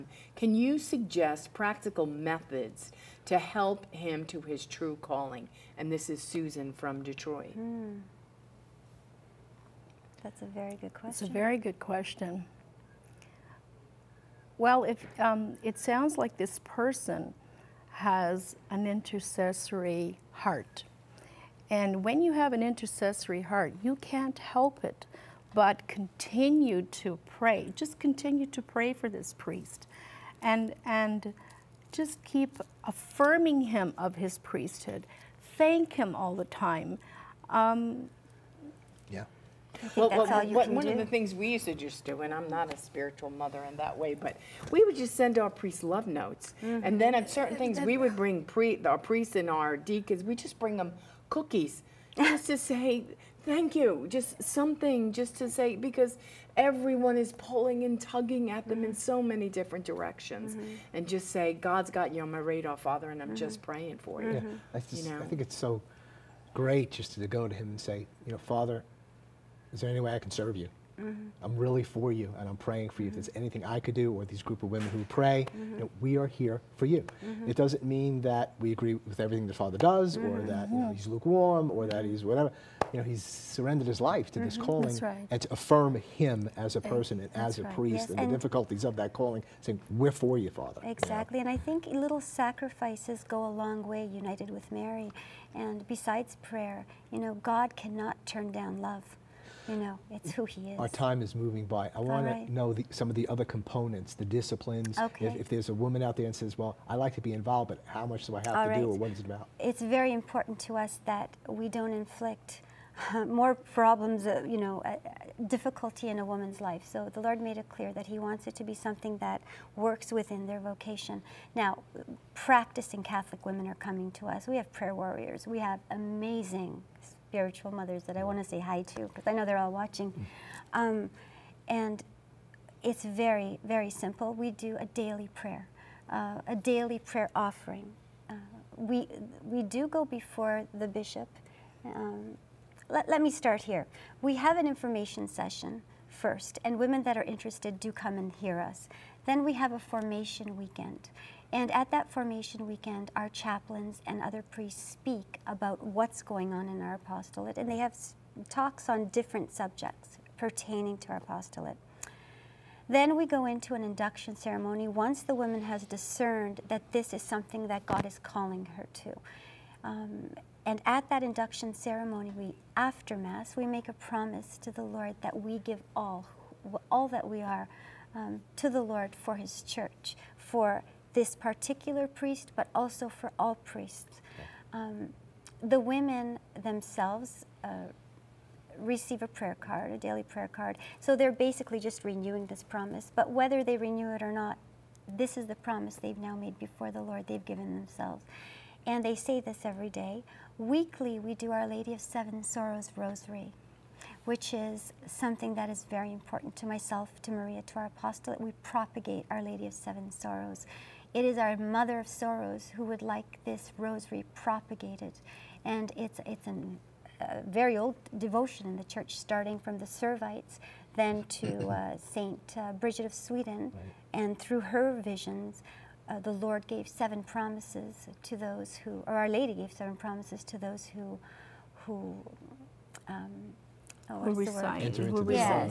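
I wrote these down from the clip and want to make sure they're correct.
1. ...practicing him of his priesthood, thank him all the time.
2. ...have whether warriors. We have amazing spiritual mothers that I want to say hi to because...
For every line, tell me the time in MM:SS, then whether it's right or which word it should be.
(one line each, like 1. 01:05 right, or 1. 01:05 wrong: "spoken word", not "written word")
1. 00:32 wrong: "affirming", not "practicing"
2. 02:04 wrong: "prayer", not "whether".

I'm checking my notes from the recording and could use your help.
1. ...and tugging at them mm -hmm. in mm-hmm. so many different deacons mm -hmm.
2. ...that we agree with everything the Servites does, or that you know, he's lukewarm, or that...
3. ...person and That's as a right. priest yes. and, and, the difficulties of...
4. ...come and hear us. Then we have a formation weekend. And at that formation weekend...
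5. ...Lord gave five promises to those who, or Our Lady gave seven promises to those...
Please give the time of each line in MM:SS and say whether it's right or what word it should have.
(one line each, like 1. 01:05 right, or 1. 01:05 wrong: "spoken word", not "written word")
1. 00:57 wrong: "directions", not "deacons"
2. 01:18 wrong: "Father", not "Servites"
3. 01:26 right
4. 02:27 right
5. 03:46 wrong: "seven", not "five".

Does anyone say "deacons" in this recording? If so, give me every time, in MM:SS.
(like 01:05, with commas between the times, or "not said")
00:49.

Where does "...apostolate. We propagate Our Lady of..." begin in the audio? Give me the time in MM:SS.
03:27.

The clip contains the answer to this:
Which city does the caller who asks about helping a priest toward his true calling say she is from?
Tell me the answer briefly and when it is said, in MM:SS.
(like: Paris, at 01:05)
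Detroit, at 00:07.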